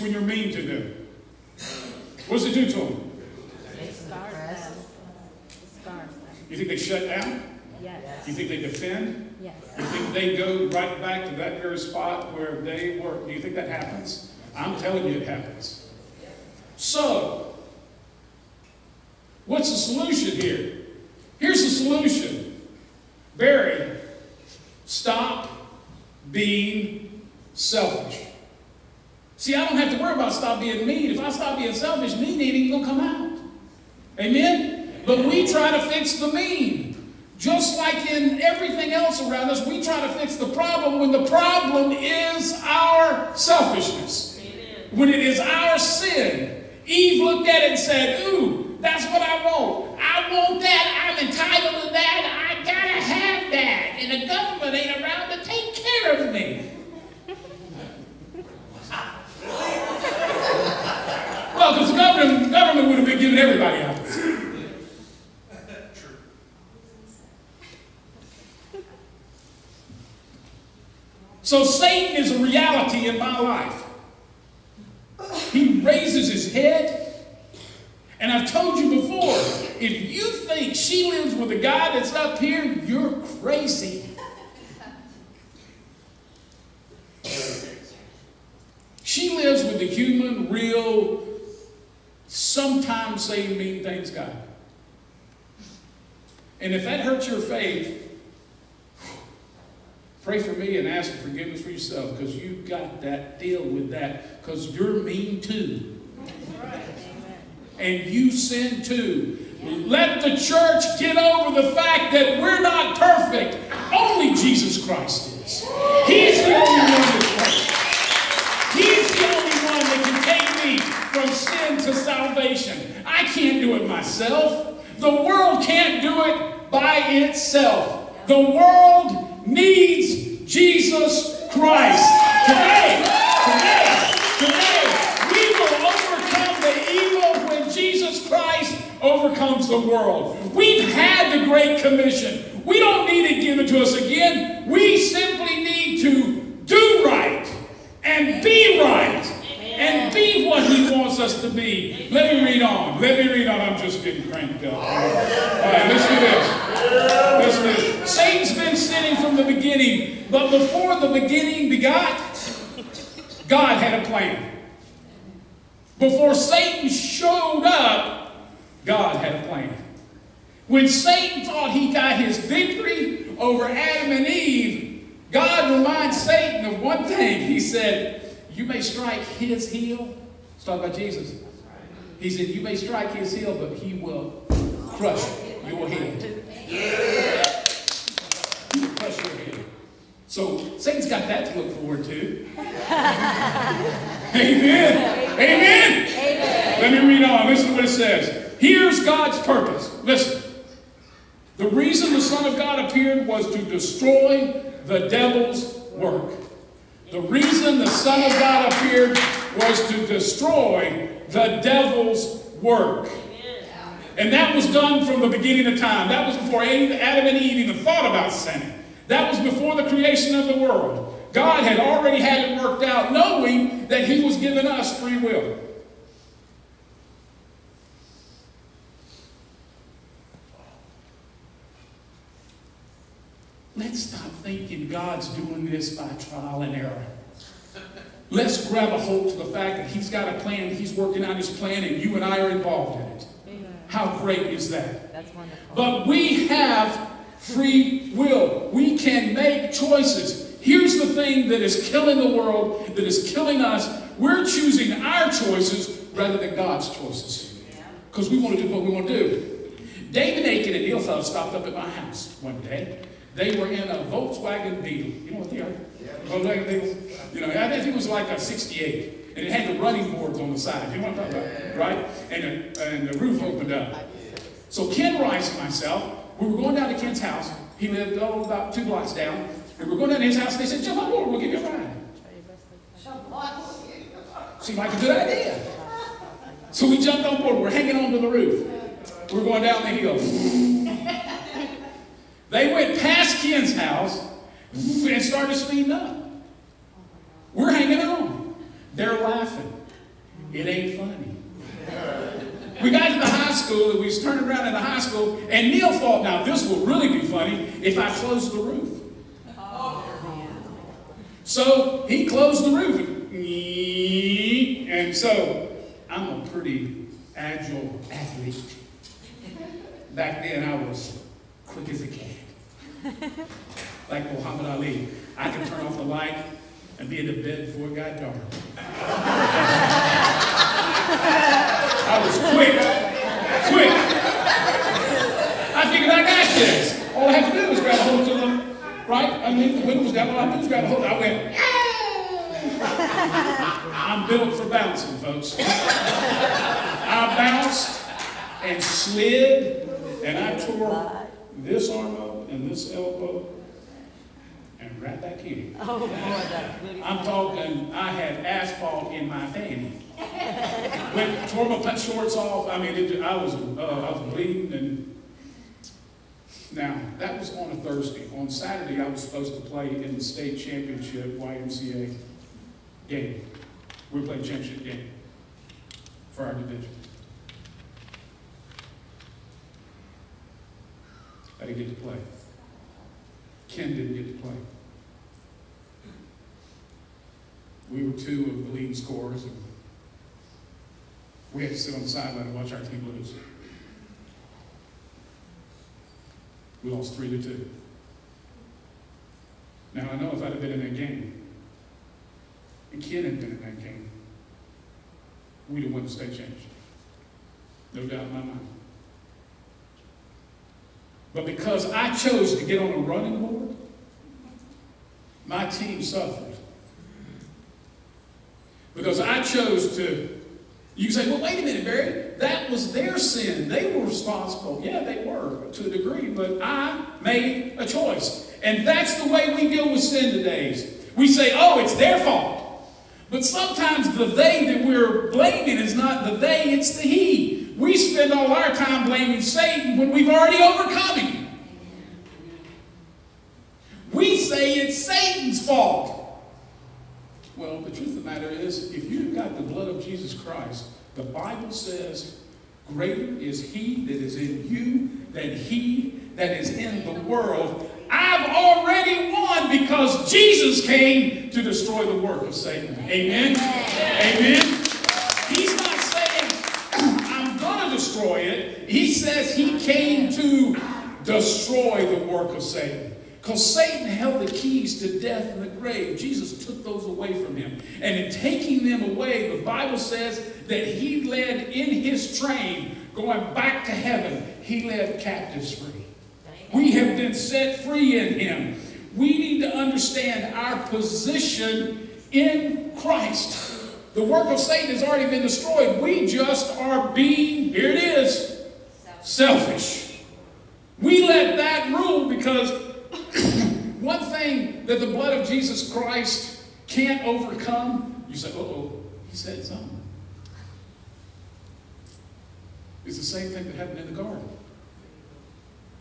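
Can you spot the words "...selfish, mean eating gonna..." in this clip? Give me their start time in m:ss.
0:31.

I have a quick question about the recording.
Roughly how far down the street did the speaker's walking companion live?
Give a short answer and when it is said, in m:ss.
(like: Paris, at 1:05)
2 blocks, at 4:38.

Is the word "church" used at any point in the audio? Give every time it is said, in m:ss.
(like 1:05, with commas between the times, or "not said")
1:50.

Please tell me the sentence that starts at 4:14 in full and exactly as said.
We're choosing our choices rather than God's choices.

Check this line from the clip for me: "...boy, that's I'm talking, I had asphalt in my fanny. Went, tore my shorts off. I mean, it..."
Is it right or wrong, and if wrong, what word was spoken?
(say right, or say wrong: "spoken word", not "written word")
right.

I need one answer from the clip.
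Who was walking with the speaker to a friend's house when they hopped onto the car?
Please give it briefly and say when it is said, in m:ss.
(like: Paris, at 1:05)
Ken Rice, at 4:34.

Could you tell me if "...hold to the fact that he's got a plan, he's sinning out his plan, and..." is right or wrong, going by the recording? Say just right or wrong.
wrong.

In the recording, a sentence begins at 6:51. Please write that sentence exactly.
But because I chose to get on a running board, my team suffered.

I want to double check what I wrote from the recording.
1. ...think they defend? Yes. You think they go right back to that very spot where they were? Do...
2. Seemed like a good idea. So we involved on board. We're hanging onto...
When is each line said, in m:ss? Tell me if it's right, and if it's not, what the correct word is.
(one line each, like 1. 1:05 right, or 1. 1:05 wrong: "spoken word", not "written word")
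1. 0:08 right
2. 4:44 wrong: "jumped", not "involved".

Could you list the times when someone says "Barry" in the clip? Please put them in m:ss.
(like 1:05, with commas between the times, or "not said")
0:23, 7:01.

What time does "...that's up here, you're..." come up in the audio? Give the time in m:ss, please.
1:21.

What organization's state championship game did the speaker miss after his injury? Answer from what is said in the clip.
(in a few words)
YMCA.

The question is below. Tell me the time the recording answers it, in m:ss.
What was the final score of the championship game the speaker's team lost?
6:37.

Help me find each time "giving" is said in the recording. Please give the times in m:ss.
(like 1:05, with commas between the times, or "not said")
1:03, 3:44.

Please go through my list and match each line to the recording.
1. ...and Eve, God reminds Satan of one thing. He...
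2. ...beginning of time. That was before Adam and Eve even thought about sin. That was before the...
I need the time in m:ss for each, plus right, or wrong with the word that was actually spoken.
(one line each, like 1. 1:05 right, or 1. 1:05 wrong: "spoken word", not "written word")
1. 2:54 right
2. 3:35 right.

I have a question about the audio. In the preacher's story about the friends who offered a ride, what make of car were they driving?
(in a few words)
Volkswagen Beetle.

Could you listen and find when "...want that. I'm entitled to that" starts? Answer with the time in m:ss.
0:50.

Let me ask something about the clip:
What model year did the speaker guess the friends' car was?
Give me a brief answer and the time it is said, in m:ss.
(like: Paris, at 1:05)
68, at 4:28.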